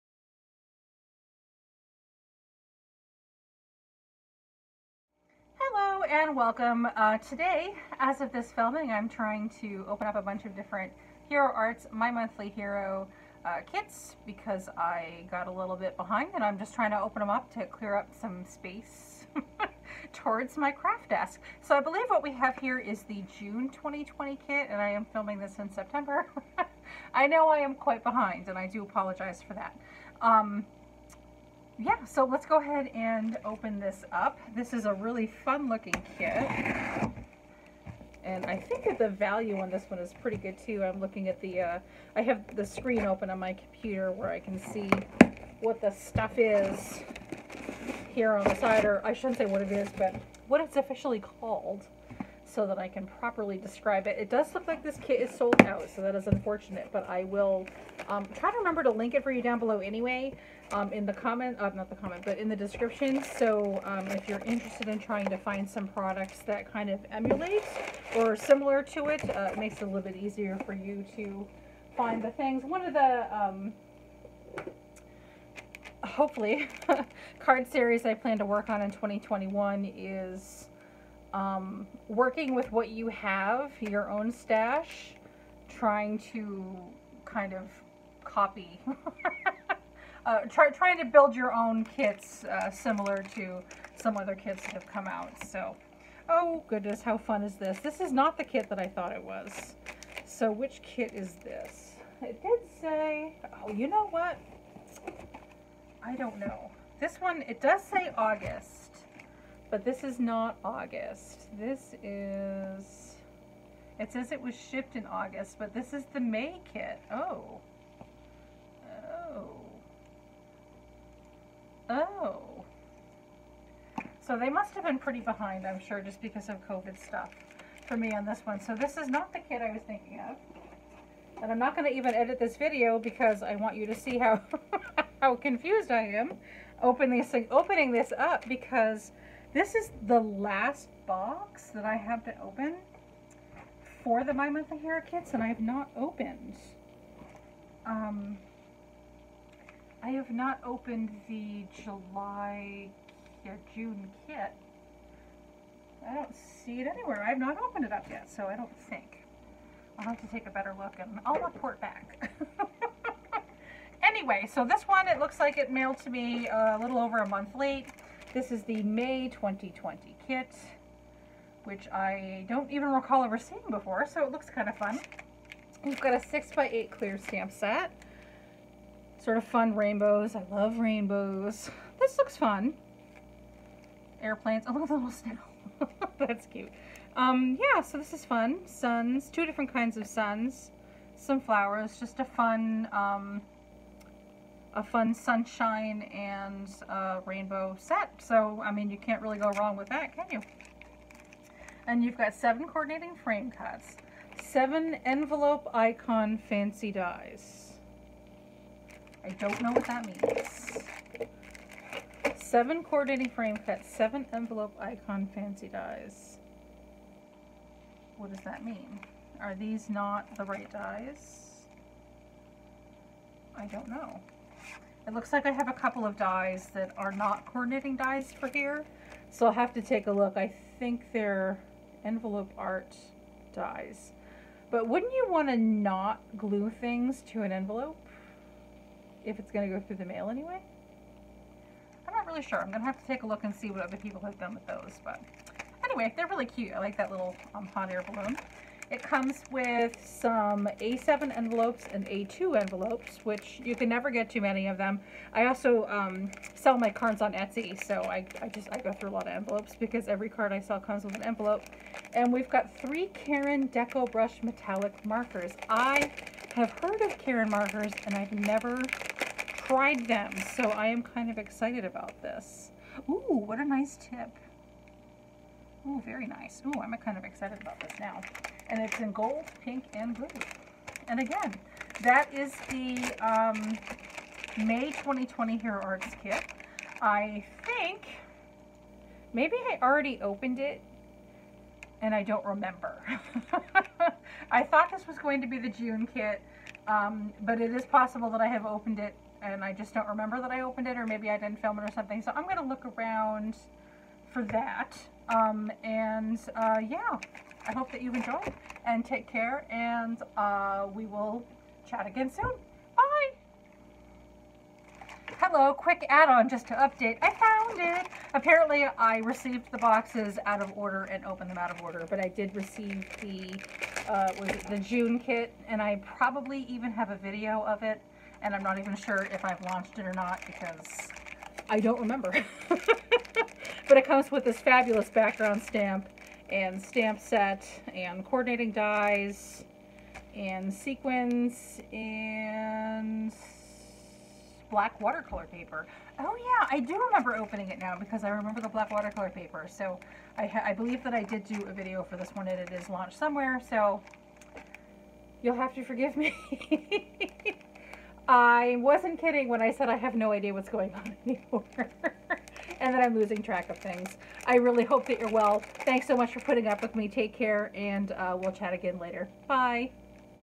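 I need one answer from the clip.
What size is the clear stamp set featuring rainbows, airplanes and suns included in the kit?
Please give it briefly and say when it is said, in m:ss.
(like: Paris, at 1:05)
6x8, at 2:56.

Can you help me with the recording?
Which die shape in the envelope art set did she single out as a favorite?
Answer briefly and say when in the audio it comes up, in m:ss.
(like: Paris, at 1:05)
hot air balloon, at 4:07.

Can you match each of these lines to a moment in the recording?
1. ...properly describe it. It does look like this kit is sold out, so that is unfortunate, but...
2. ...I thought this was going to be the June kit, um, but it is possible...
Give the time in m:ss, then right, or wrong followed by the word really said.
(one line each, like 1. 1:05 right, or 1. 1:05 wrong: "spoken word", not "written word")
1. 0:53 right
2. 4:54 right.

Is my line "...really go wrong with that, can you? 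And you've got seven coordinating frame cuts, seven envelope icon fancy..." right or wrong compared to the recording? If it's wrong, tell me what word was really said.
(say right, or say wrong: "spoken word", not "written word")
right.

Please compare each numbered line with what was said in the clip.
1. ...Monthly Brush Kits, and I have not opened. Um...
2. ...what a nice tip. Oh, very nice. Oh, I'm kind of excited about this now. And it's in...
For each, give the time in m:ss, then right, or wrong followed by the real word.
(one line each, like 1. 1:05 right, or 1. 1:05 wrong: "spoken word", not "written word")
1. 2:24 wrong: "Hero", not "Brush"
2. 4:33 right.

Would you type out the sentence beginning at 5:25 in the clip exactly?
And I probably even have a video of it.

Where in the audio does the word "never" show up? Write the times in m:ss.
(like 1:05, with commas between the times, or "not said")
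4:13, 4:28.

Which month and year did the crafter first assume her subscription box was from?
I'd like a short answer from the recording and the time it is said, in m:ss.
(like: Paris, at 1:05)
June 2020, at 0:23.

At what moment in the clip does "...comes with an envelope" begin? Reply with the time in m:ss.
4:20.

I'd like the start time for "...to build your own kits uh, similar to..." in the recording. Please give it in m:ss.
1:30.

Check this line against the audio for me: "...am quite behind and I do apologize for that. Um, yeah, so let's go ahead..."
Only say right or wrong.
right.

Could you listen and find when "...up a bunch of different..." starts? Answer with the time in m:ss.
0:10.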